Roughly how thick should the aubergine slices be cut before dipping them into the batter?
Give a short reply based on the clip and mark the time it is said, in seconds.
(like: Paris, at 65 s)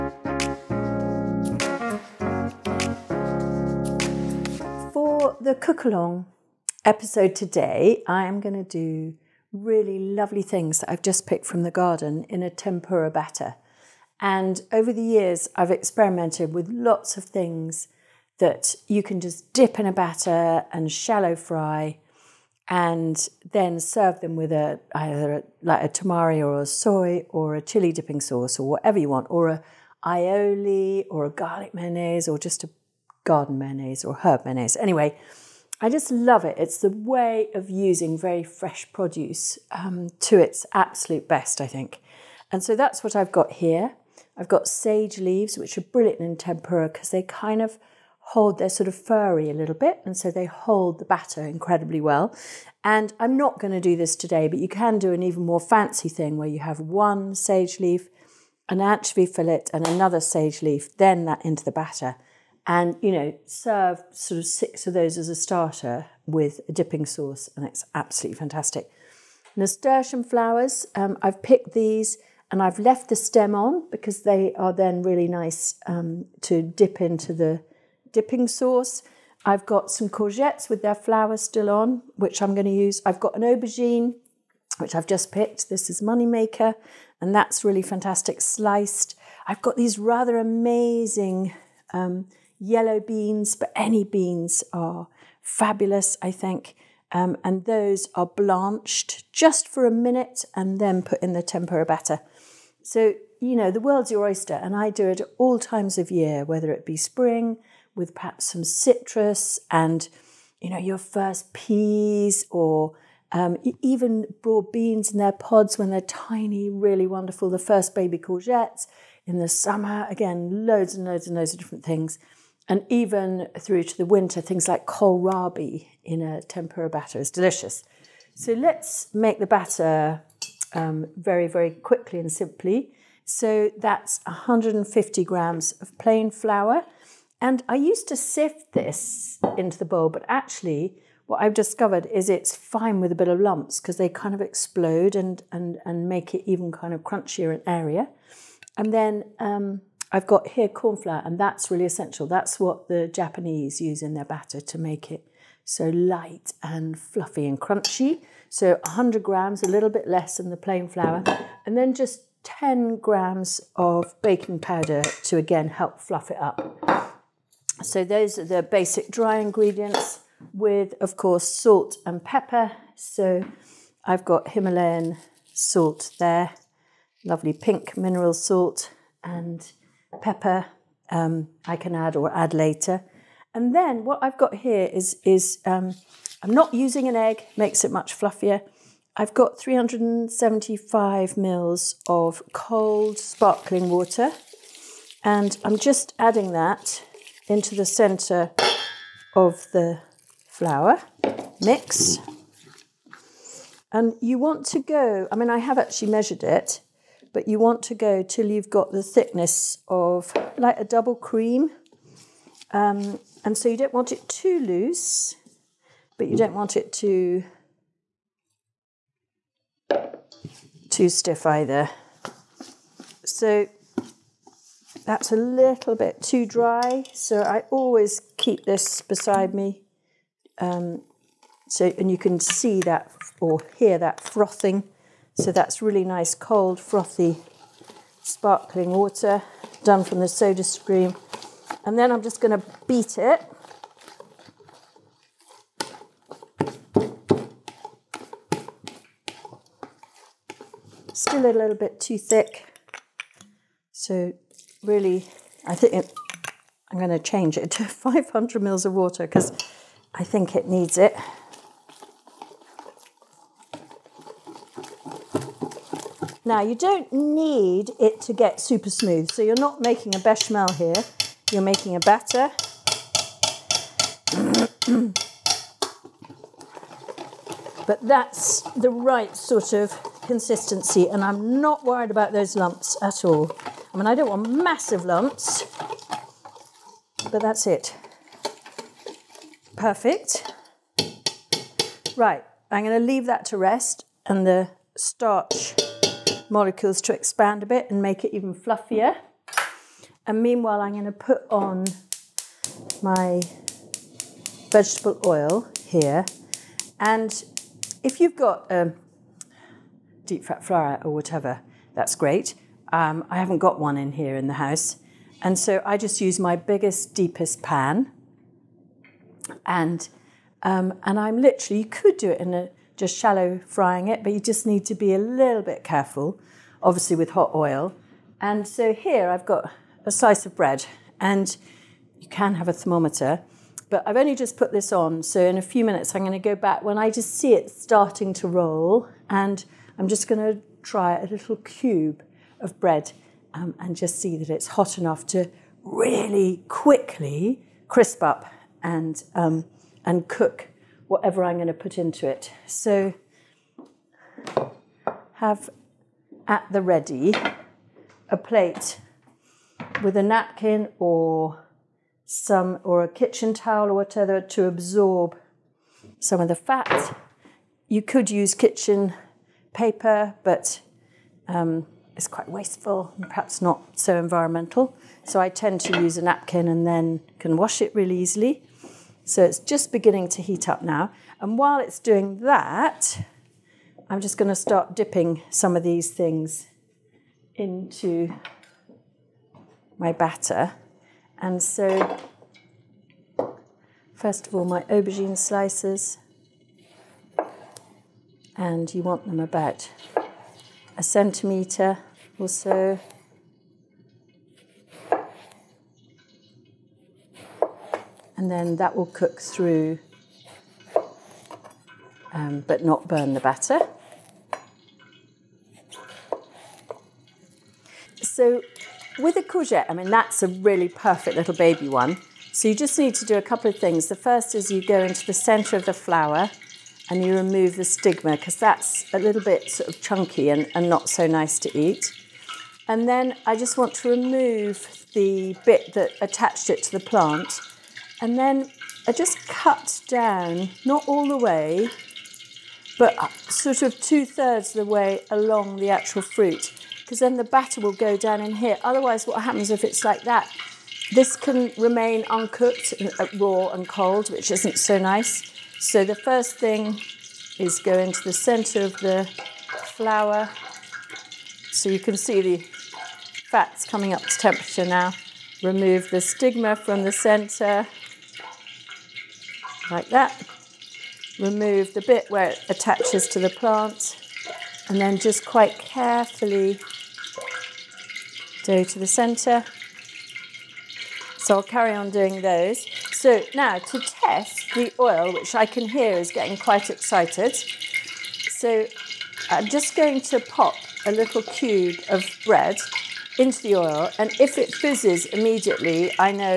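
About a centimetre, at 400 s.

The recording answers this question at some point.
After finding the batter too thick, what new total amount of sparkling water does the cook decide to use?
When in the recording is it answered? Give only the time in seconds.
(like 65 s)
257 s.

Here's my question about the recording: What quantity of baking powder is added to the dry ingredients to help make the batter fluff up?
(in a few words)
10 grams.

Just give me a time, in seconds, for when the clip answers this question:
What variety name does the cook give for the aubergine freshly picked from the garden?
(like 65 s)
86 s.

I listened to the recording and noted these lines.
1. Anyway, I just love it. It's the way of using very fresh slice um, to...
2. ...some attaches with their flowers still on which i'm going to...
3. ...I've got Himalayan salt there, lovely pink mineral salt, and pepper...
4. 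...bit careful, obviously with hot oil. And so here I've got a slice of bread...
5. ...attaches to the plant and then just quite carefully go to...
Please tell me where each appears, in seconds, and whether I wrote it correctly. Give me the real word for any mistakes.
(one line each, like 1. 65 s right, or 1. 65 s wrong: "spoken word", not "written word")
1. 34 s wrong: "produce", not "slice"
2. 79 s wrong: "courgettes", not "attaches"
3. 174 s right
4. 325 s right
5. 472 s right.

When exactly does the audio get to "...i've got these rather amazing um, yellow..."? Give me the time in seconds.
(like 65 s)
89 s.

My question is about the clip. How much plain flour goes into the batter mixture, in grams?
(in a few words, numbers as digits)
150 grams.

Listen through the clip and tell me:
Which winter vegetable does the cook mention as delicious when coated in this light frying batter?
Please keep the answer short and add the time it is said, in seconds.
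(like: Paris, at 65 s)
Kohlrabi, at 124 s.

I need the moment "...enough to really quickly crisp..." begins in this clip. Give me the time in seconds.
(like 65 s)
344 s.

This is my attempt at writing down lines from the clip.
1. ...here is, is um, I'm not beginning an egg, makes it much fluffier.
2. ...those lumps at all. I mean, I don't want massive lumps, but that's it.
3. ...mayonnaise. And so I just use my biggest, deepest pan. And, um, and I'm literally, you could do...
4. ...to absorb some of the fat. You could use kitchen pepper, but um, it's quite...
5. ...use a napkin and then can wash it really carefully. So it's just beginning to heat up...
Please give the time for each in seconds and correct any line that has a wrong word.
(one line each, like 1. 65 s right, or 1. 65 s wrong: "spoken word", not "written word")
1. 184 s wrong: "using", not "beginning"
2. 282 s right
3. 314 s wrong: "house", not "mayonnaise"
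4. 364 s wrong: "paper", not "pepper"
5. 376 s wrong: "easily", not "carefully".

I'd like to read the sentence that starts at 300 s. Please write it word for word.
And meanwhile, I'm going to put on my vegetable oil here.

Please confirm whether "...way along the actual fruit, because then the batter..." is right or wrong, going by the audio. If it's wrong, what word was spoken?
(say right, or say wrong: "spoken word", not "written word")
right.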